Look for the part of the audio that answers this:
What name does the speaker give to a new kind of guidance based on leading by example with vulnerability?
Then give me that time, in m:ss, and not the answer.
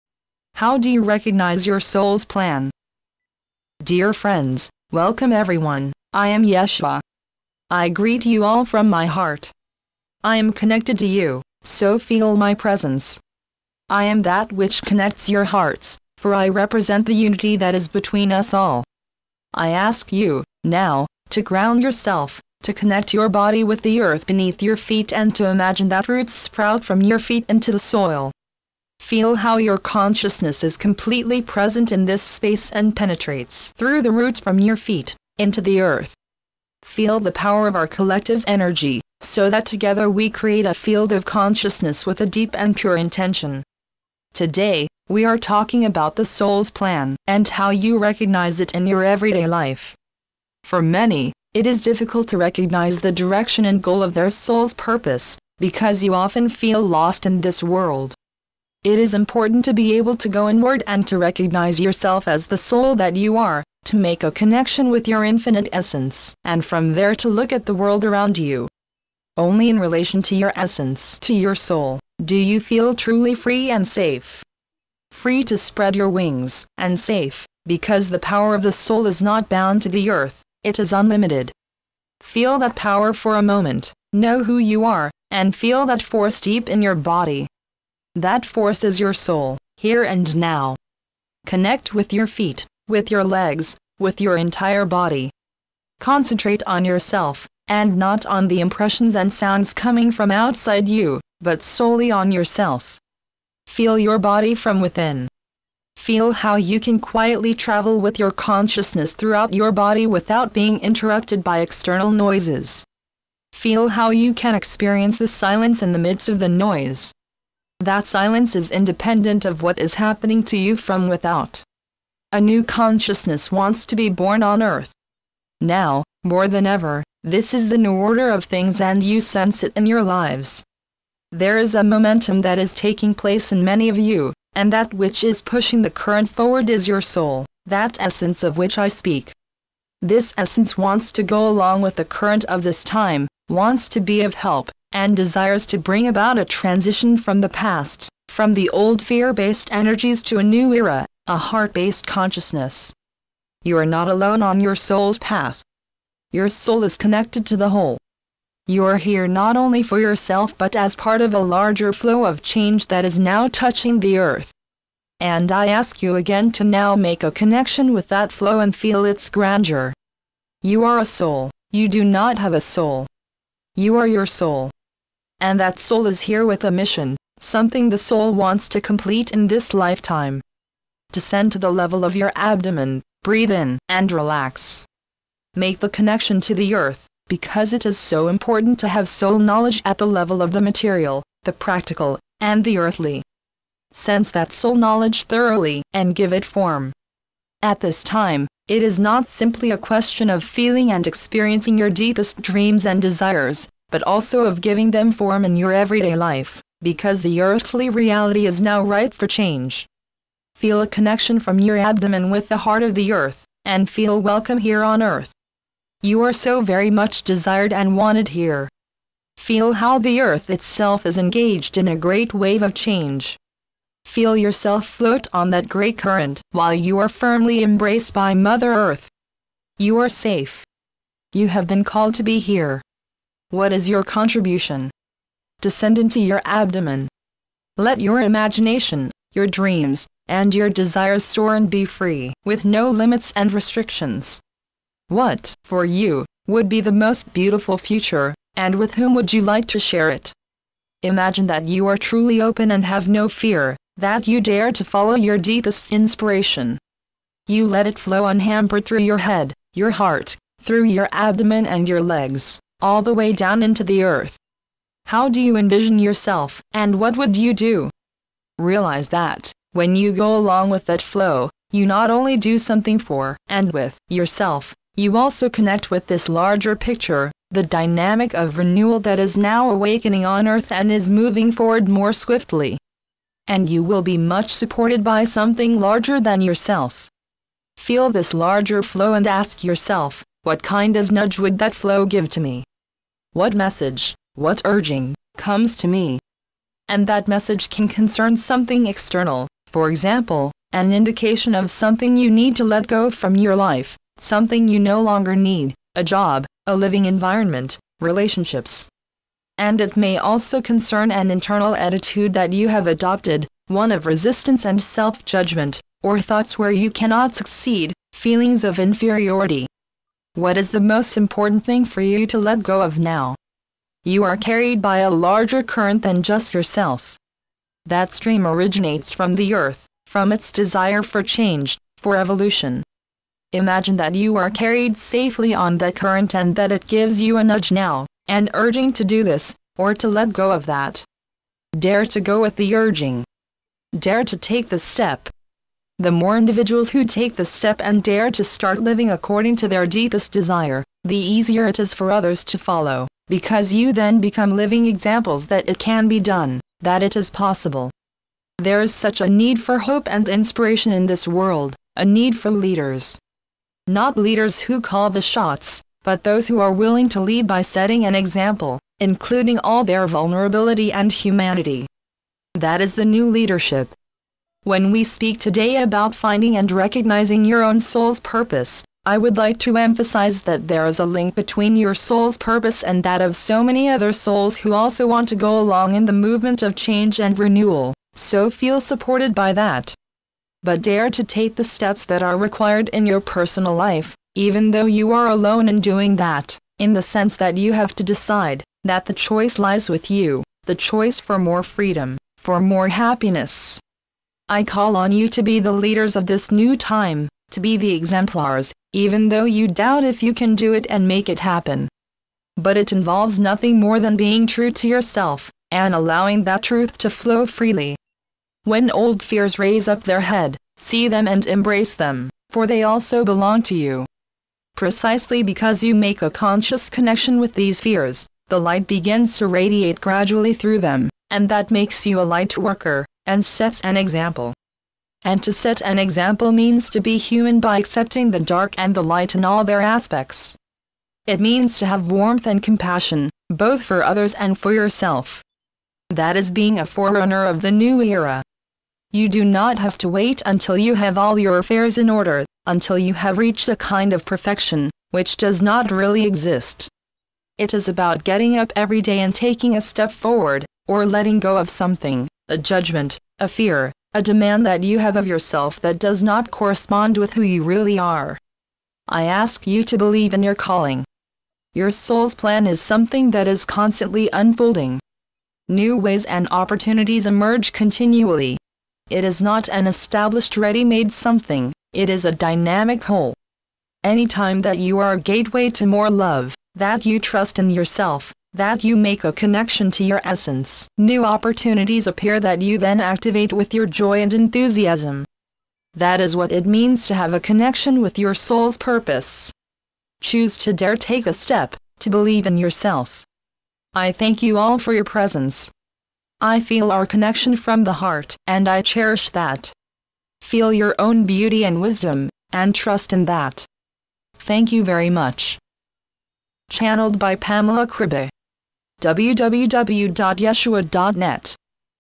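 6:12.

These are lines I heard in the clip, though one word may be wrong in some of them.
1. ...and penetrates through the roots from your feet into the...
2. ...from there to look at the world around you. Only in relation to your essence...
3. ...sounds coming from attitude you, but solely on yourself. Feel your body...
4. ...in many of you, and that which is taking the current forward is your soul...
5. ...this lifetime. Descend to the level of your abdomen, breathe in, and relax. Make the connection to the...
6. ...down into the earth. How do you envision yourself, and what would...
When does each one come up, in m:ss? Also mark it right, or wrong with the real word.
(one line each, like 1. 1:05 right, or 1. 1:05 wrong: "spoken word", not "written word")
1. 0:32 right
2. 1:06 right
3. 1:39 wrong: "outside", not "attitude"
4. 2:13 wrong: "pushing", not "taking"
5. 2:59 right
6. 4:23 right.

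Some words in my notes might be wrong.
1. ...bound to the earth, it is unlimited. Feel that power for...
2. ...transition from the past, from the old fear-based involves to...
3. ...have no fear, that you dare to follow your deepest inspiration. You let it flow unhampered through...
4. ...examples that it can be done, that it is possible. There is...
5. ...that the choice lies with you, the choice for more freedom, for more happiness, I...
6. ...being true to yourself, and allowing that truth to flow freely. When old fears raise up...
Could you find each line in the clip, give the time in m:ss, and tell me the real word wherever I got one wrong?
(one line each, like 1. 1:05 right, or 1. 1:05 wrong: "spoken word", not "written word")
1. 1:19 right
2. 2:26 wrong: "energies", not "involves"
3. 4:12 right
4. 5:54 right
5. 6:38 right
6. 6:54 right.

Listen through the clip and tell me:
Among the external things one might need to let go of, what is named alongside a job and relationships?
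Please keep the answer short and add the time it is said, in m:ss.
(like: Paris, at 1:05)
A living environment, at 5:06.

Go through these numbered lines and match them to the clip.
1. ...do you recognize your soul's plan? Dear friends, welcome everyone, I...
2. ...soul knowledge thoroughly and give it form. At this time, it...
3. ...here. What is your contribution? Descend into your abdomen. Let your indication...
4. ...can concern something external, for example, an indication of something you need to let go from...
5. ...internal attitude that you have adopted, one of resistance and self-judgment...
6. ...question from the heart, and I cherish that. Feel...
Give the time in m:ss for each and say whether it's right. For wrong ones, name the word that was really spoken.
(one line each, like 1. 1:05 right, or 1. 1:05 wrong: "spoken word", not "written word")
1. 0:00 right
2. 3:14 right
3. 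3:52 wrong: "imagination", not "indication"
4. 4:57 right
5. 5:11 right
6. 8:27 wrong: "connection", not "question".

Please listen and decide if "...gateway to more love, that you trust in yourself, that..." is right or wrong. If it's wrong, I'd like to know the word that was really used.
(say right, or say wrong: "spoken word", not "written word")
right.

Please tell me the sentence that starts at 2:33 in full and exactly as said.
You are not alone on your soul's path.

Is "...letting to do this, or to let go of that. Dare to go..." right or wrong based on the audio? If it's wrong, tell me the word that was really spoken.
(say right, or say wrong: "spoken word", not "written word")
wrong: "urging", not "letting".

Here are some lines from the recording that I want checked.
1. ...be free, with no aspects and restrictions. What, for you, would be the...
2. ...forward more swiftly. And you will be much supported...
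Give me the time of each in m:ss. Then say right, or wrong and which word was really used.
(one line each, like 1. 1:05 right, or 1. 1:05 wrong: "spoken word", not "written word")
1. 4:01 wrong: "limits", not "aspects"
2. 4:41 right.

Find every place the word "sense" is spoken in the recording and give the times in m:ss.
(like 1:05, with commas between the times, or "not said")
2:09, 3:13, 6:37.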